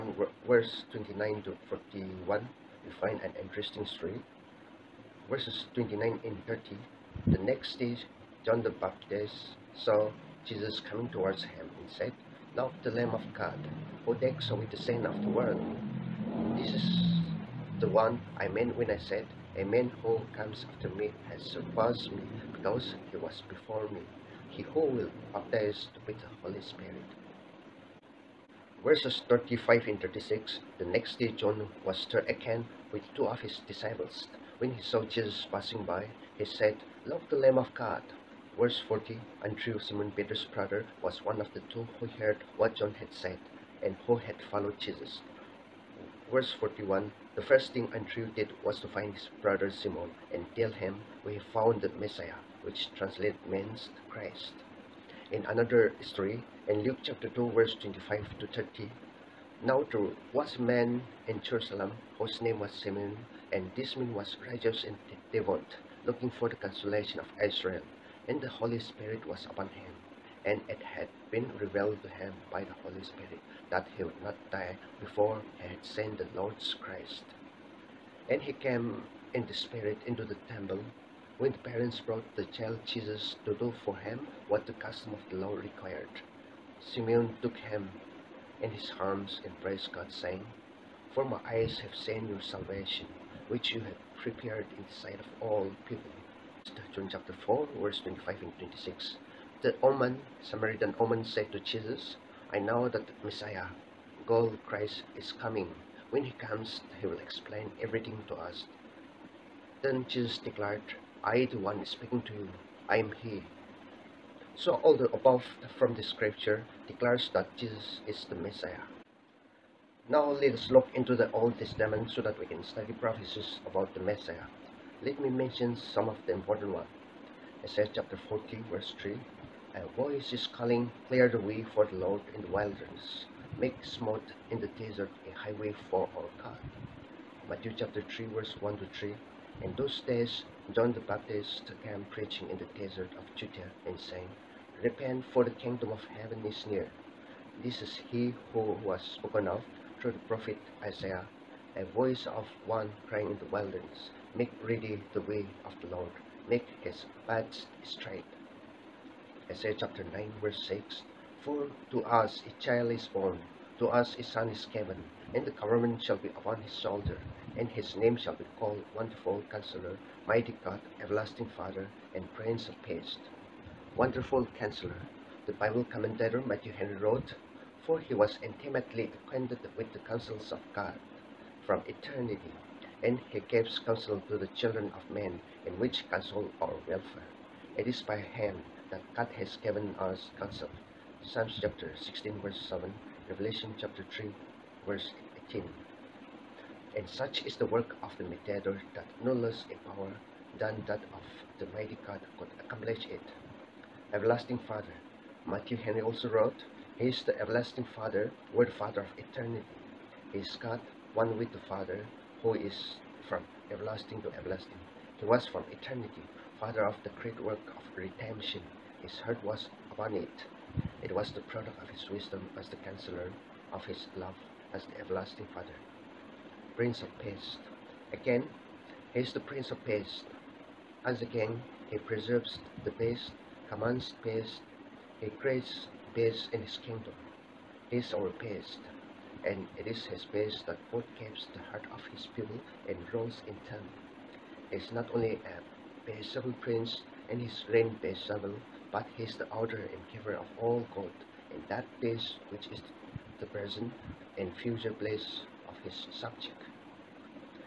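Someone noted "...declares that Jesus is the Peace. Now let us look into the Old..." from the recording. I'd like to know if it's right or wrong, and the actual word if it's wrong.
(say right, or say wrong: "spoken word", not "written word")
wrong: "Messiah", not "Peace".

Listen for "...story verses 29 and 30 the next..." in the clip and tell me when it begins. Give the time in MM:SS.
00:03.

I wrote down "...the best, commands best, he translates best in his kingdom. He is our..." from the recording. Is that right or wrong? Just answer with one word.
wrong.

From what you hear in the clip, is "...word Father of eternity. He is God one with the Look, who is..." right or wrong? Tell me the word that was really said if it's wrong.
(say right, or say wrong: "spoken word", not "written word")
wrong: "Father", not "Look".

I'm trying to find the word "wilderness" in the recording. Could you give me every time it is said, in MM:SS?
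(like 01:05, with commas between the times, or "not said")
02:12, 02:33.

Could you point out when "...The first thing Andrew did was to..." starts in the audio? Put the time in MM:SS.
00:47.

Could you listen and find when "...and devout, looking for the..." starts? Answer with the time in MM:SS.
01:04.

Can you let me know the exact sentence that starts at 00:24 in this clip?
He who will baptize with the Holy Spirit.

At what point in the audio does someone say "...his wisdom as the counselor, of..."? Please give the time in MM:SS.
03:41.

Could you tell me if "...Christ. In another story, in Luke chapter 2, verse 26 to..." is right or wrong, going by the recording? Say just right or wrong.
wrong.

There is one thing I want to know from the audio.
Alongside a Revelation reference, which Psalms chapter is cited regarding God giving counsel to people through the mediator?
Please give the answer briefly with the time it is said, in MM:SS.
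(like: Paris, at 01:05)
Psalm 16, at 03:11.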